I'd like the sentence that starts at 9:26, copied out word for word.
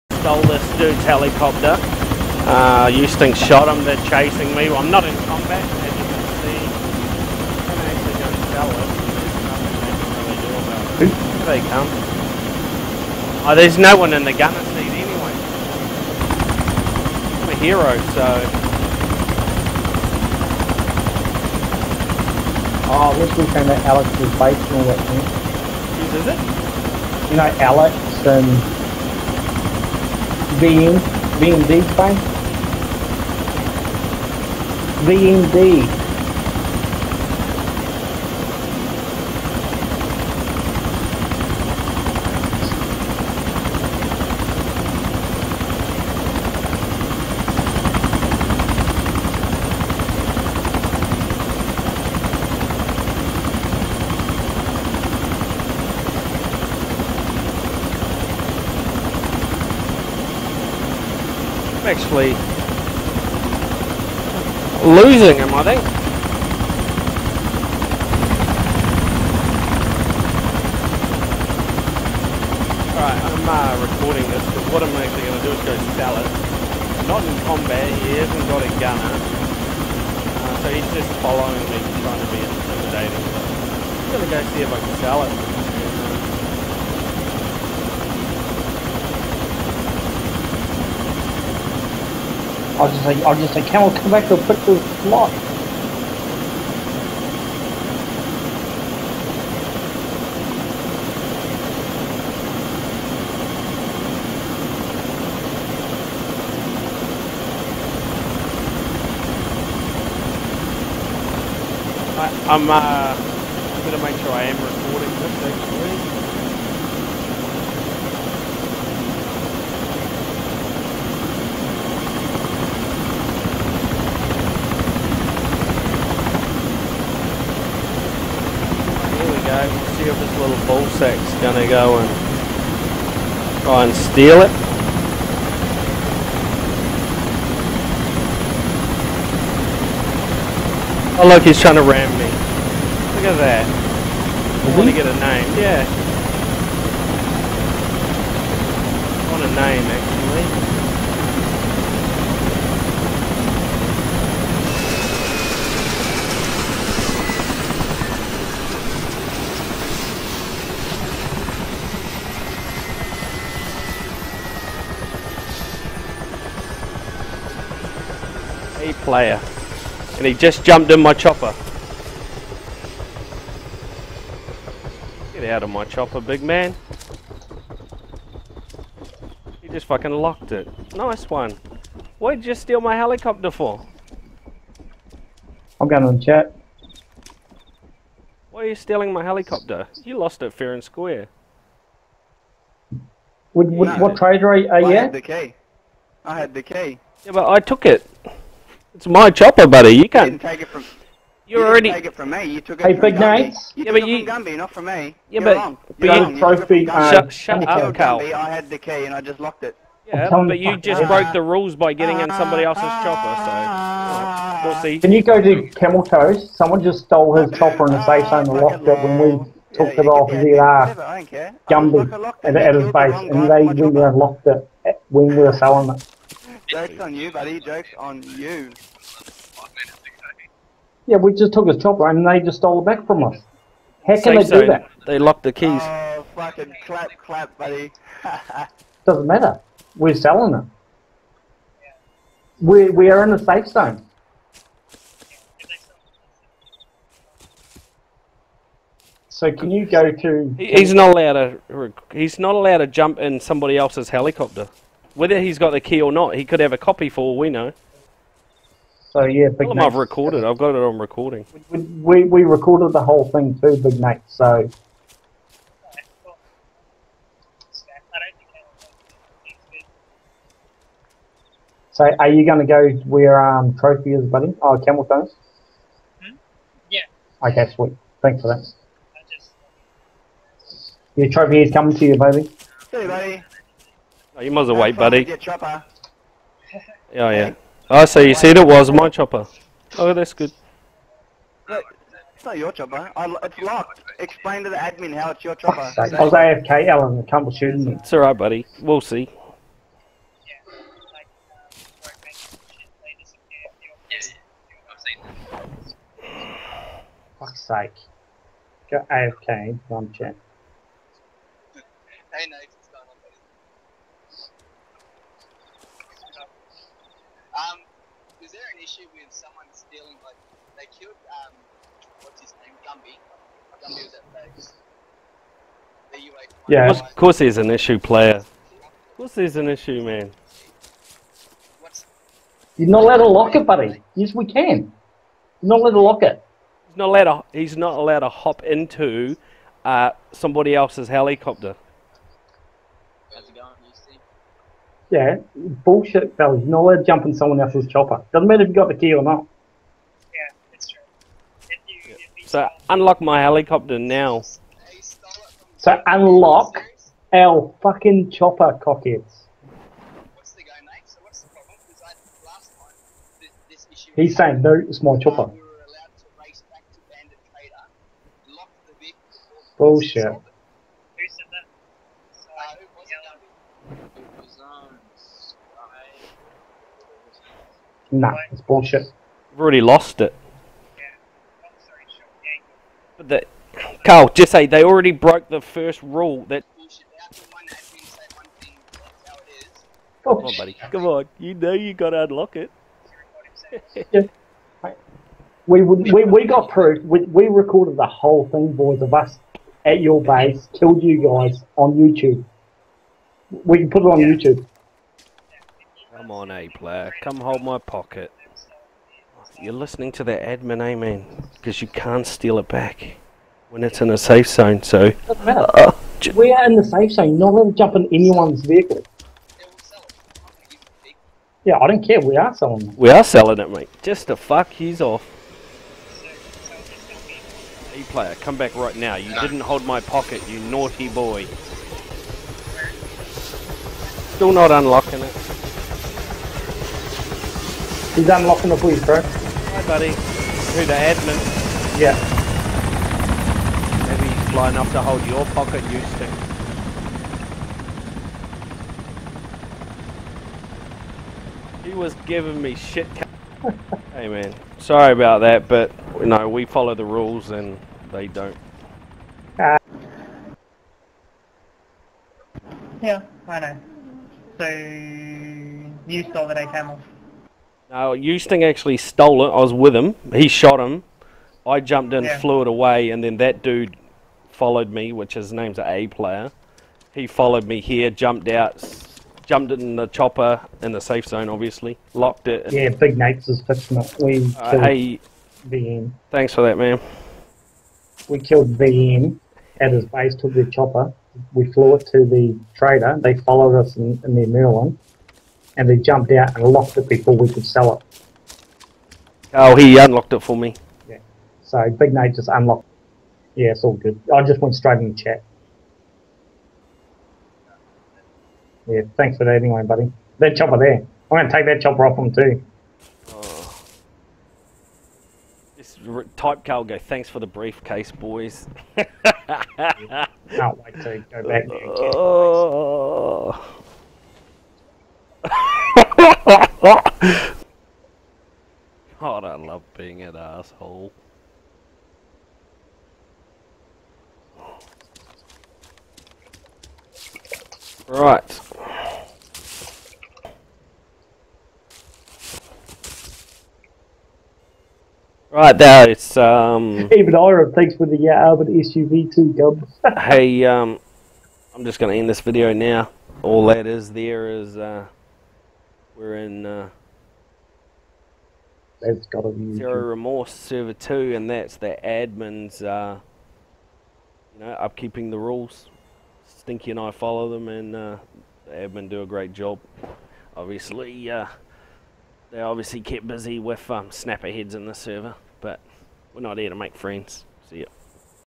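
Stinky and I follow them, and uh, the admin do a great job.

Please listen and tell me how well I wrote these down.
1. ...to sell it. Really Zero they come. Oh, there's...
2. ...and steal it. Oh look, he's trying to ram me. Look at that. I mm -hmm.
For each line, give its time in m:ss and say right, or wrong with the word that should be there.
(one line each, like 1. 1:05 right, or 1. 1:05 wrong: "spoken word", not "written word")
1. 0:08 wrong: "Here", not "Zero"
2. 2:13 right.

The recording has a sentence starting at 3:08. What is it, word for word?
Why are you stealing my helicopter?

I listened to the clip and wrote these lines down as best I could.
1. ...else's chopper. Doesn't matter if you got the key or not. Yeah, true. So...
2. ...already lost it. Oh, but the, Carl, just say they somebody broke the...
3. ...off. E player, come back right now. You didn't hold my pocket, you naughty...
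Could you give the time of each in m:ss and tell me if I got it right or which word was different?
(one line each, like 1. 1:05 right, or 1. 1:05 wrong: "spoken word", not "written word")
1. 5:47 right
2. 6:19 wrong: "already", not "somebody"
3. 7:05 right.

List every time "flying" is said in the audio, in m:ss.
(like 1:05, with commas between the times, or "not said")
7:24.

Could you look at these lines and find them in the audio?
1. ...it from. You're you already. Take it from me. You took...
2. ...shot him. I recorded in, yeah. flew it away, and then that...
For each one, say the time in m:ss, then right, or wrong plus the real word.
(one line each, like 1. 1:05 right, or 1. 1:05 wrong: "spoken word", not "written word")
1. 3:20 right
2. 7:50 wrong: "jumped", not "recorded".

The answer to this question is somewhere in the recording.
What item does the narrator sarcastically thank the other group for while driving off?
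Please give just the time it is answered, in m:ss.
8:36.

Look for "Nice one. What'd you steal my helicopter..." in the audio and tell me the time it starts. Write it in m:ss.
3:00.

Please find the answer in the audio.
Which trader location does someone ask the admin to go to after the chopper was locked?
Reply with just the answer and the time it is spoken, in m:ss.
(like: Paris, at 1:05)
Camel Toes, at 3:34.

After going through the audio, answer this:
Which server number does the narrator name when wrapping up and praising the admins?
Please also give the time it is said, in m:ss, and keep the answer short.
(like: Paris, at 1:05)
2, at 9:19.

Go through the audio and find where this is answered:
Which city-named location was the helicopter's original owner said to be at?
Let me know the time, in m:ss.
5:23.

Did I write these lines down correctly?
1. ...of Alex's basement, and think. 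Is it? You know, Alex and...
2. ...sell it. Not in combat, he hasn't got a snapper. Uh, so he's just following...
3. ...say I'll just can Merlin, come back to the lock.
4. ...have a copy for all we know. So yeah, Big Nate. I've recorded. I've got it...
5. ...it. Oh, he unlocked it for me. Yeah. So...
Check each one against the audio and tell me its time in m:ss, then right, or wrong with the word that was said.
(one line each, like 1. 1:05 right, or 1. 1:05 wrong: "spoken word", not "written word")
1. 0:23 right
2. 1:15 wrong: "gunner", not "snapper"
3. 1:33 wrong: "Camel", not "Merlin"
4. 4:16 right
5. 8:17 right.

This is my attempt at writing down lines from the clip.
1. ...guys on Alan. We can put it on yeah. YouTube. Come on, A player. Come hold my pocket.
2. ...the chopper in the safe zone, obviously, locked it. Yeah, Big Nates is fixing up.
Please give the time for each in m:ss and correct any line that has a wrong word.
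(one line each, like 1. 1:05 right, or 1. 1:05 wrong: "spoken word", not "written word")
1. 6:41 wrong: "YouTube", not "Alan"
2. 7:59 right.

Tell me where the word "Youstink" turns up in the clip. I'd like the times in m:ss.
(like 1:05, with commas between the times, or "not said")
0:02, 7:48.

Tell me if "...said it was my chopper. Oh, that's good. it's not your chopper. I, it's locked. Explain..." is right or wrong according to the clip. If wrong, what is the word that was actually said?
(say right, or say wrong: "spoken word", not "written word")
right.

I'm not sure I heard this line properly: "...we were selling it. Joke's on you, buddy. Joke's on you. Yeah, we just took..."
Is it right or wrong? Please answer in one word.
right.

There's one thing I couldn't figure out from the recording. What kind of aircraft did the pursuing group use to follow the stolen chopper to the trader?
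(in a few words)
Merlin.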